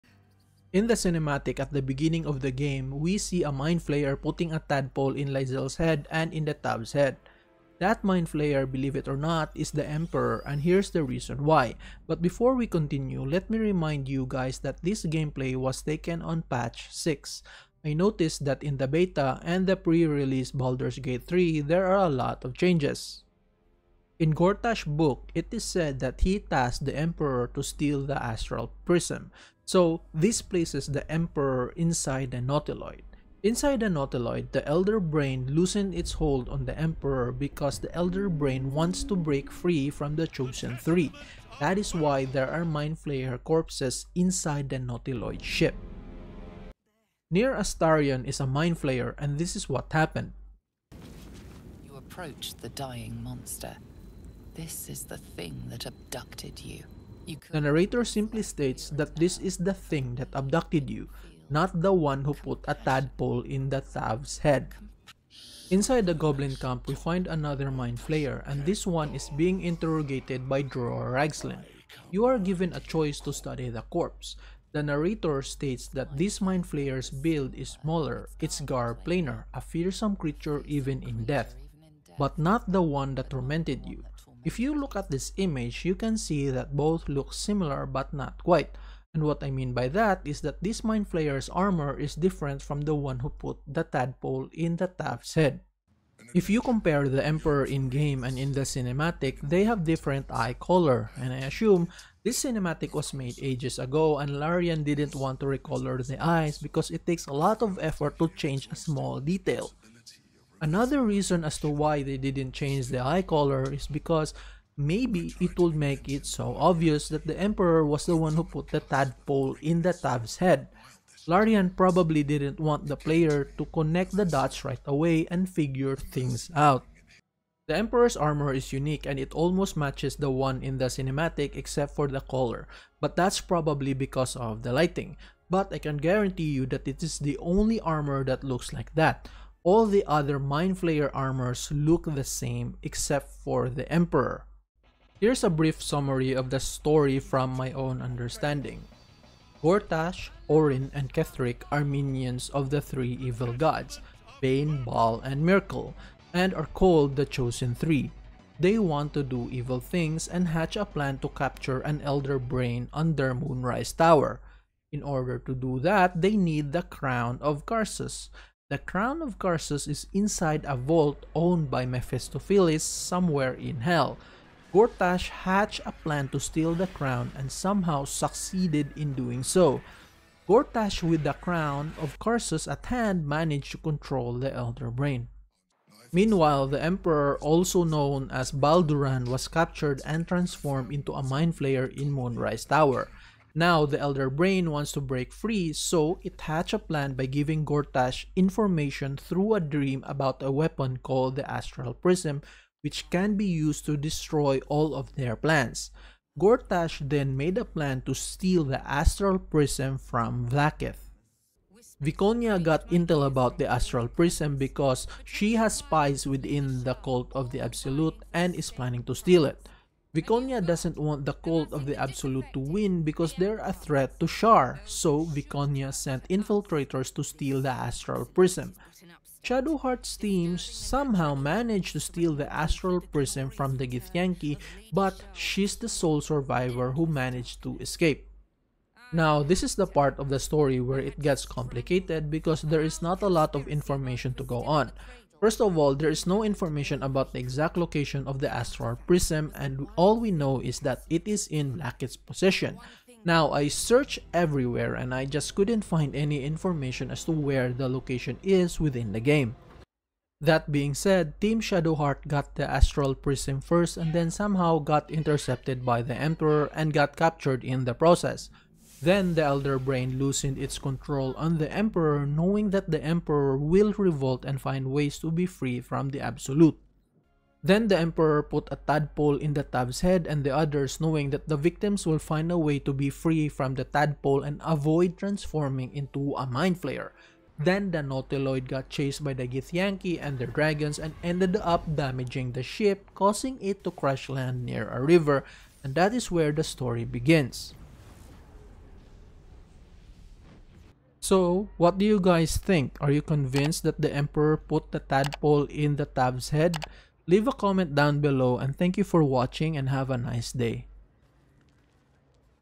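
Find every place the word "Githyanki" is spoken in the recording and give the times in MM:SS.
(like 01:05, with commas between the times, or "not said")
03:53, 04:49.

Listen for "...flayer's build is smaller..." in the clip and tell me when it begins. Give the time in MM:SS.
01:16.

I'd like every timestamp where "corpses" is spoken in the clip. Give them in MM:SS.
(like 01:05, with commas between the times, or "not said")
00:43, 01:13.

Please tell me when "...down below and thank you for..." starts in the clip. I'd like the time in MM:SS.
05:07.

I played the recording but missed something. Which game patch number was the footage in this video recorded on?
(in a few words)
6.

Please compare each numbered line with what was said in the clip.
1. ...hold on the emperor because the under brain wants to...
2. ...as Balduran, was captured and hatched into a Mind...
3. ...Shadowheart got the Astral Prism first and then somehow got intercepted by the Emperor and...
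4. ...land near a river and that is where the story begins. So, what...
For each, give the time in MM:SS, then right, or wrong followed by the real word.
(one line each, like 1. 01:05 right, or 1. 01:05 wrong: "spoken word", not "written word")
1. 00:36 wrong: "elder", not "under"
2. 03:08 wrong: "transformed", not "hatched"
3. 04:21 right
4. 04:54 right.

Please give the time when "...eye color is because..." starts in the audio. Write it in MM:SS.
01:53.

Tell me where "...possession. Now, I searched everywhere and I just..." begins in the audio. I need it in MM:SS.
04:12.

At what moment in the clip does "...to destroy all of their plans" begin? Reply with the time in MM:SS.
03:23.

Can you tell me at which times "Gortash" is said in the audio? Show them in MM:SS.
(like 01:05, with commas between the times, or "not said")
00:24, 02:29, 02:54, 03:00, 03:17, 03:26.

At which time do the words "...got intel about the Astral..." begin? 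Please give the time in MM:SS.
03:32.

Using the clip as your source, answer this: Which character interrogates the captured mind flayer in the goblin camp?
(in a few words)
Dror Ragzlin.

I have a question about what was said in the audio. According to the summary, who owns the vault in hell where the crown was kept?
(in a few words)
Mephistopheles.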